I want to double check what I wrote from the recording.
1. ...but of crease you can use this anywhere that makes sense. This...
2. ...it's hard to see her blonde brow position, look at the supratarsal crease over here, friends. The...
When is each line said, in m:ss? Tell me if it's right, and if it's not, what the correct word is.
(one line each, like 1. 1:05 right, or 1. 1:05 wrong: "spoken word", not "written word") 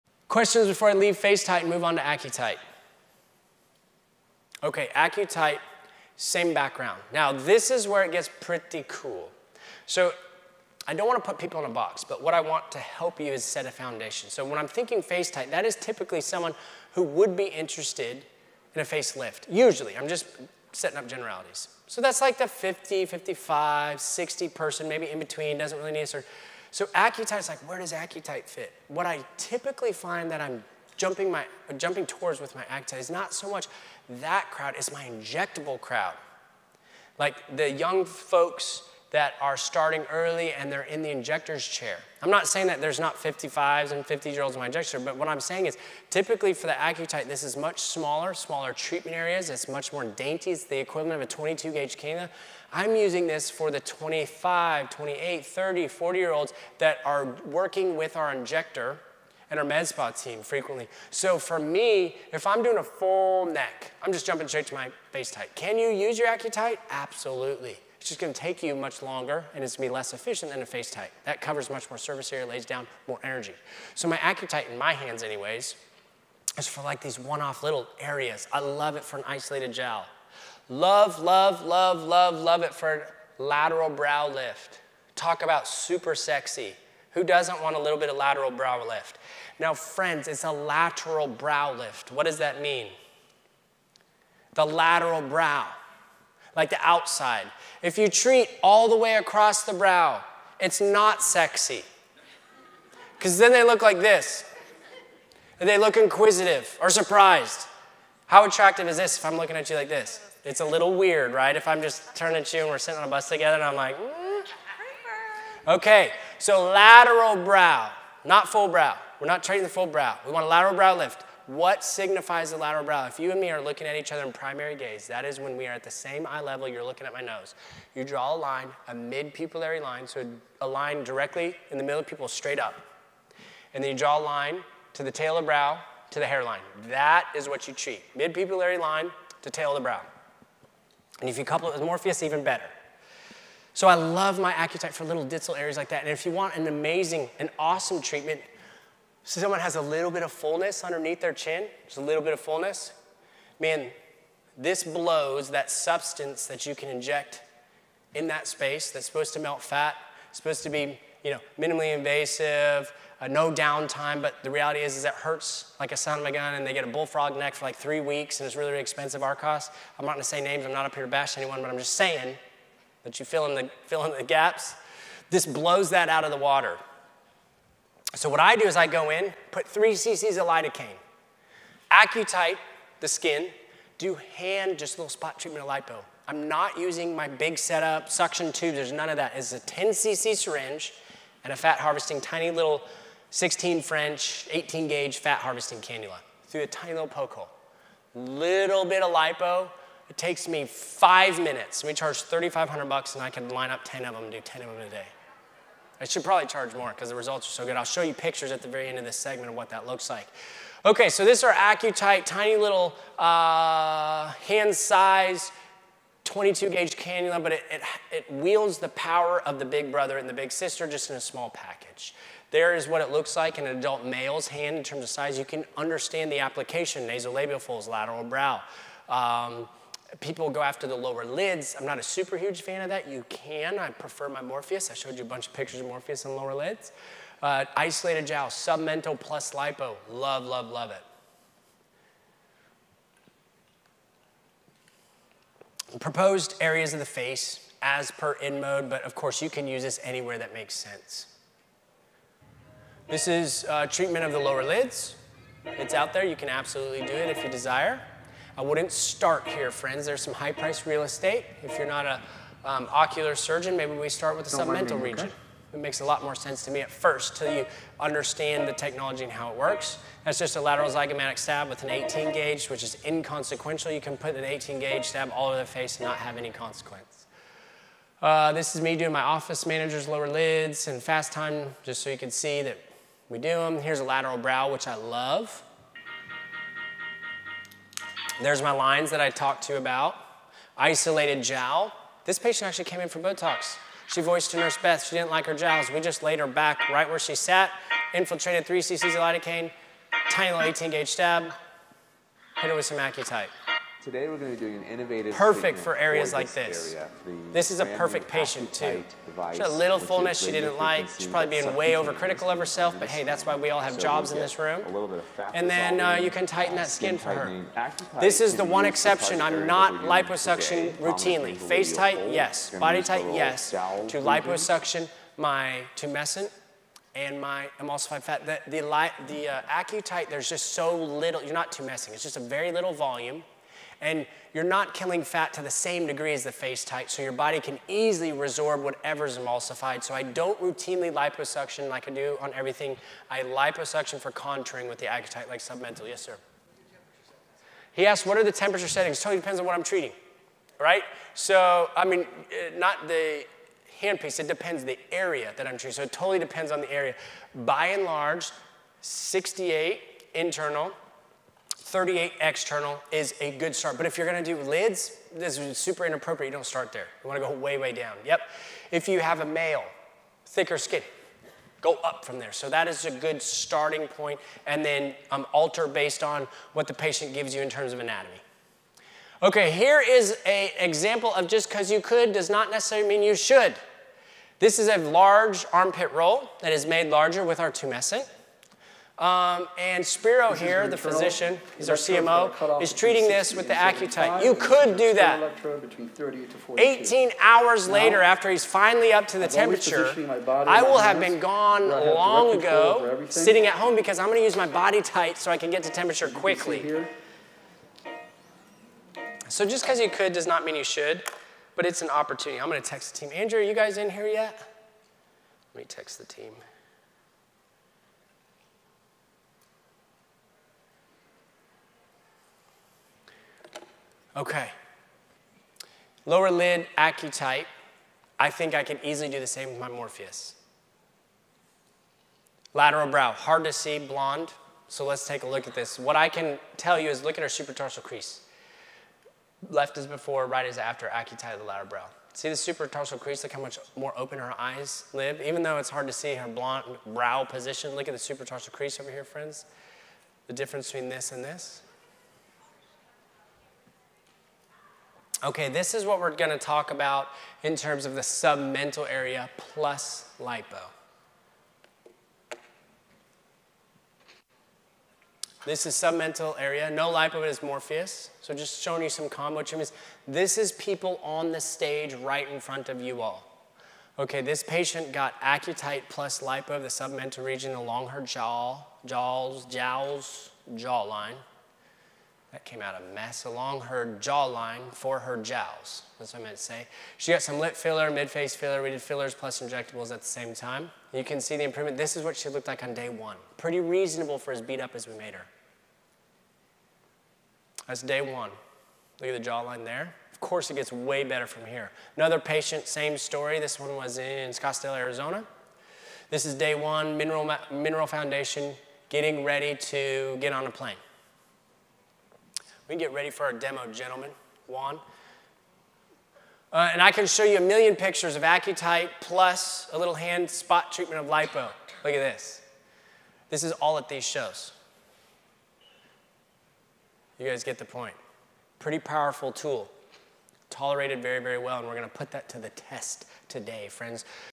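1. 4:08 wrong: "course", not "crease"
2. 7:25 right.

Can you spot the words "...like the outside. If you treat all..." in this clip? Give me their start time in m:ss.
1:36.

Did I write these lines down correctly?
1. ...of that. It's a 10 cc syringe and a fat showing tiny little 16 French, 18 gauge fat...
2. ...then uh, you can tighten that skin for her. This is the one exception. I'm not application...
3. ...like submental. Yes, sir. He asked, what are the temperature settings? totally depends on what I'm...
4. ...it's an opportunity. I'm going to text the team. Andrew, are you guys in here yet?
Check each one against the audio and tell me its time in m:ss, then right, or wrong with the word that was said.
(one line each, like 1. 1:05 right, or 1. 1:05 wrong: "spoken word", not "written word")
1. 3:09 wrong: "harvesting", not "showing"
2. 5:15 wrong: "liposuction", not "application"
3. 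5:45 right
4. 6:51 right.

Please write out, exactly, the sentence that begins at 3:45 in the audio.
You can understand the application, nasolabial folds, lateral brow.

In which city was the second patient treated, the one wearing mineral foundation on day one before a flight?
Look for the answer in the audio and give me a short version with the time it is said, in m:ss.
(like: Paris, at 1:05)
Scottsdale, Arizona, at 8:24.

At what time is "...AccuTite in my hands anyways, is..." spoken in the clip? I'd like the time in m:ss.
1:14.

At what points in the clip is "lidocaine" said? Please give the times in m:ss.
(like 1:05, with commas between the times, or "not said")
3:00, 4:59.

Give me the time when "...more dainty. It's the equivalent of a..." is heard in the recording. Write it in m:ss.
0:49.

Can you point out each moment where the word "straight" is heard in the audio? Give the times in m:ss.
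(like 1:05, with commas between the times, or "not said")
1:04, 2:12.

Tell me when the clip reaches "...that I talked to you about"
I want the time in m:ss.
4:49.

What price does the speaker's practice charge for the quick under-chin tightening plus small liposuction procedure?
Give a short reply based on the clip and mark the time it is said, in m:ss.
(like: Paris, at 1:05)
$3,500, at 3:22.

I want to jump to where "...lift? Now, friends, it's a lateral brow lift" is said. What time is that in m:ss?
1:28.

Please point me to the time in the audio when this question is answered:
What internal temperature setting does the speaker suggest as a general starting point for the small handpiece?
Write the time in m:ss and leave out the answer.
5:59.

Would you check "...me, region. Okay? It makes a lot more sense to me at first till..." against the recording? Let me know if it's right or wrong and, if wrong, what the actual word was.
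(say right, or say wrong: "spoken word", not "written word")
right.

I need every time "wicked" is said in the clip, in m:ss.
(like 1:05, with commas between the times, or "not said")
not said.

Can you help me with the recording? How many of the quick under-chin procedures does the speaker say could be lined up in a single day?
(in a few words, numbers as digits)
10.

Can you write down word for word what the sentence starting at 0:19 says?
Usually, I'm just setting up generalities.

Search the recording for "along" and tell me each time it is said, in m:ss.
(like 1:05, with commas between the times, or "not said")
7:57, 8:03.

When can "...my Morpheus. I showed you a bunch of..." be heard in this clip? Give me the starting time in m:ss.
3:54.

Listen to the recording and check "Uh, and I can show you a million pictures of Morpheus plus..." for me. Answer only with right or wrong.
wrong.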